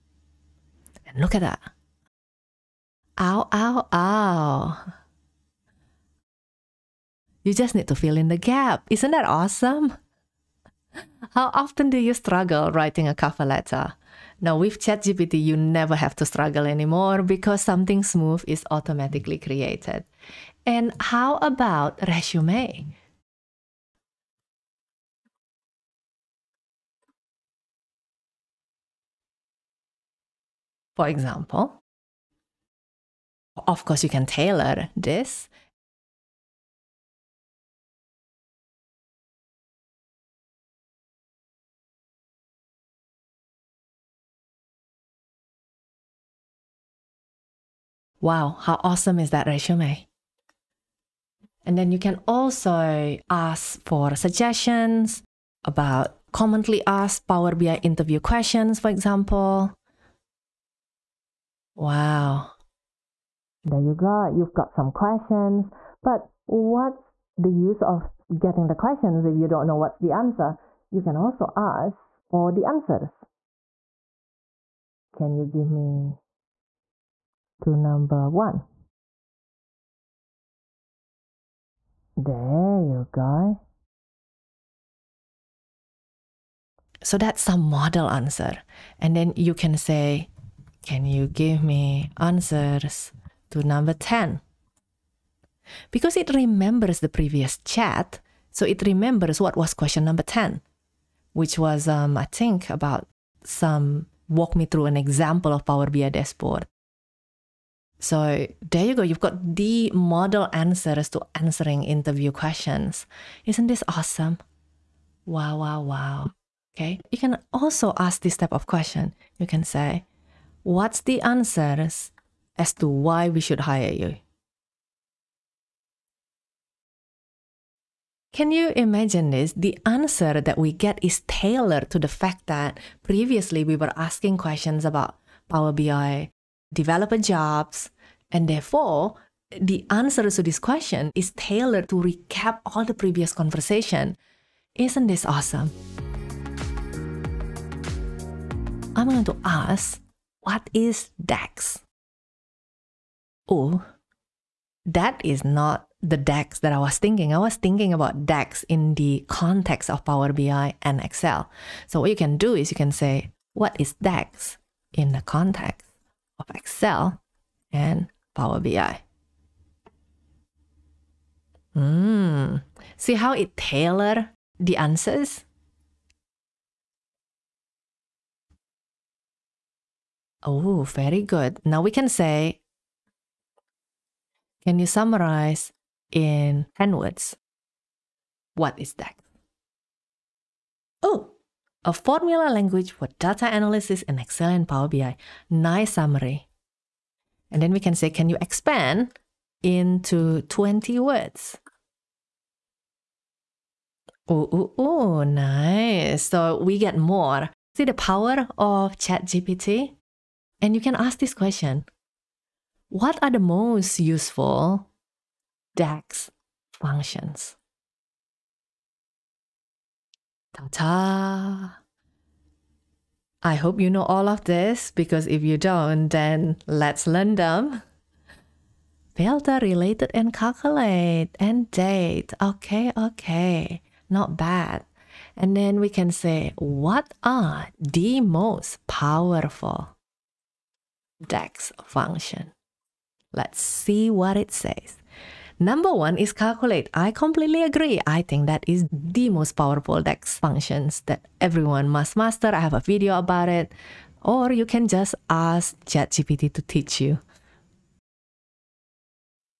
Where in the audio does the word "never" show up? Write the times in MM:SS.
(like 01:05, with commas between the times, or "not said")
00:15.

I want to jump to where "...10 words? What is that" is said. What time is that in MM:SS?
03:06.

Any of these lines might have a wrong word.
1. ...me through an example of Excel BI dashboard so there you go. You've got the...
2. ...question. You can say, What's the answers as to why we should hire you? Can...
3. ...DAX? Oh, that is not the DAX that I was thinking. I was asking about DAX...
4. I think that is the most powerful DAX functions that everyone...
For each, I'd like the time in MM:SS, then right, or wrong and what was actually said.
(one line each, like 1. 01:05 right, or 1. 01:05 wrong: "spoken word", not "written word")
1. 01:44 wrong: "Power", not "Excel"
2. 01:58 right
3. 02:31 wrong: "thinking", not "asking"
4. 04:08 right.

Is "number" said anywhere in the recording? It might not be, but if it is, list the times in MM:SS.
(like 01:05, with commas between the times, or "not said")
01:17, 01:33, 01:40, 04:05.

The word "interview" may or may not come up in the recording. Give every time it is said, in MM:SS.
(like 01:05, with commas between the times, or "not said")
00:57, 01:51.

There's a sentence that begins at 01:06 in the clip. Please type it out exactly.
But what's the use of getting the questions if you don't know what's the answer?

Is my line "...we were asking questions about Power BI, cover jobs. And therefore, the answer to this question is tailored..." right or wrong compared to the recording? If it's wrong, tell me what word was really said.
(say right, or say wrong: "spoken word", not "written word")
wrong: "developer", not "cover".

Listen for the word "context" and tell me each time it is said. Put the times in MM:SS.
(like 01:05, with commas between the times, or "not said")
02:39, 02:45.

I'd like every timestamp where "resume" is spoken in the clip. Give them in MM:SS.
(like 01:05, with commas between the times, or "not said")
00:22, 00:49.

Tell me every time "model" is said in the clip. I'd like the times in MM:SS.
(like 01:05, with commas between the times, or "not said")
01:27, 01:49.